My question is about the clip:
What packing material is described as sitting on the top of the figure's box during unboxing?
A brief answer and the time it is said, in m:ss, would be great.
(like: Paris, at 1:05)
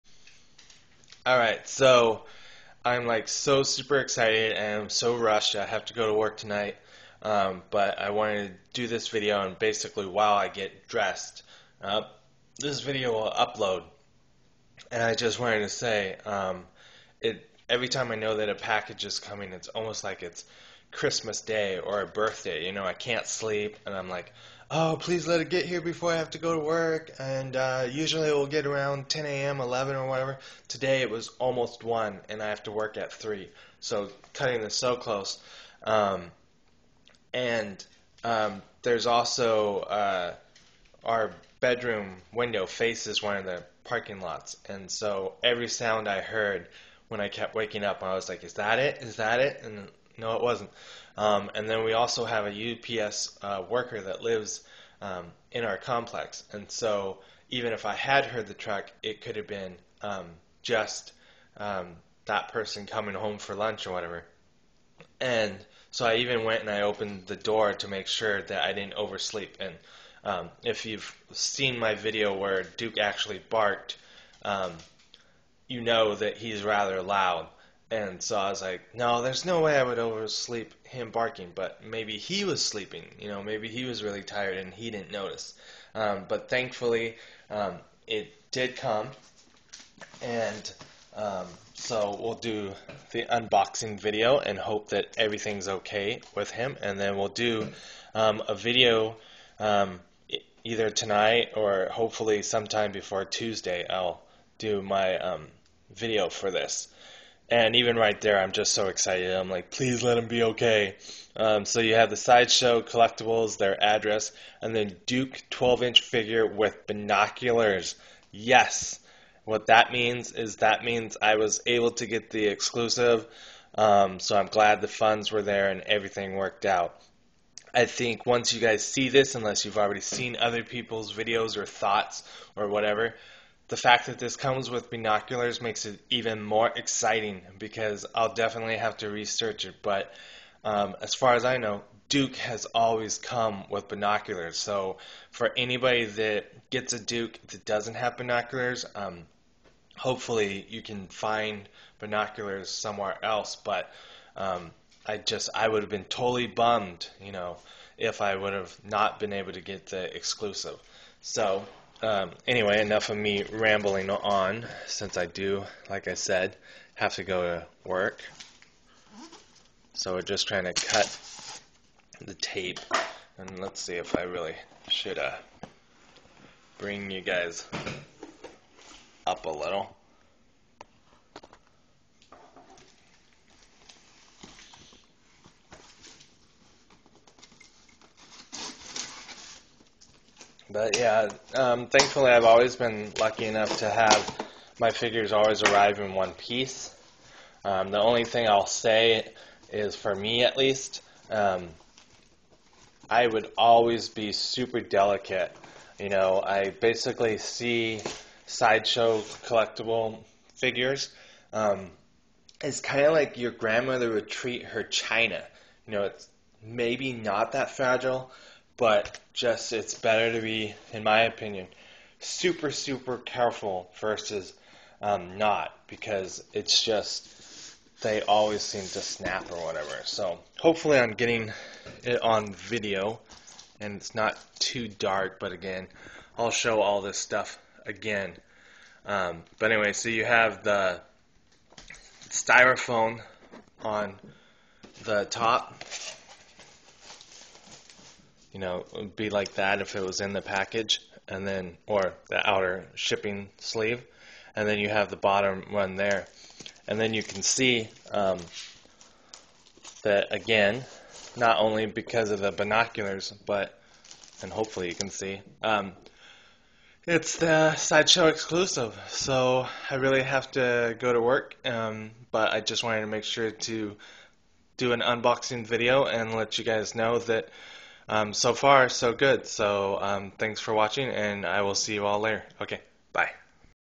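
Styrofoam, at 4:02.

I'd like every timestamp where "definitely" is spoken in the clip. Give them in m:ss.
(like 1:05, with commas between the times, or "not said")
2:18.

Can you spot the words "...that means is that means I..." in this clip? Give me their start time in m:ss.
1:59.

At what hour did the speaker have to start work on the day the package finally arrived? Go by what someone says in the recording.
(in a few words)
3.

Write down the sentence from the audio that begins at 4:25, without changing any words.
Um, it's the sideshow exclusive, so I really have to go to work.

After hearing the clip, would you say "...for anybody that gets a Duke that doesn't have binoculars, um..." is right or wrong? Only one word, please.
right.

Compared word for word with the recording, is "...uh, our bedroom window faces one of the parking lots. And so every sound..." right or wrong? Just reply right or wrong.
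right.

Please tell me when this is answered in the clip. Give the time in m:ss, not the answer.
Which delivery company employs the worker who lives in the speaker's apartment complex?
0:53.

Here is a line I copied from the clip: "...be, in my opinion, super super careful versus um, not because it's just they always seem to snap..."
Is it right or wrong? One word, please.
right.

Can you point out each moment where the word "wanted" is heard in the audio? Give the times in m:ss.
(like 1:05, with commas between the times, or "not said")
0:08, 0:15, 4:32.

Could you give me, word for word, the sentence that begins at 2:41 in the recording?
So um, anyway, enough of me rambling on, since I do, like I said, have to go to work.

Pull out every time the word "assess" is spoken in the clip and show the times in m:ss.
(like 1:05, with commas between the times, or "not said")
not said.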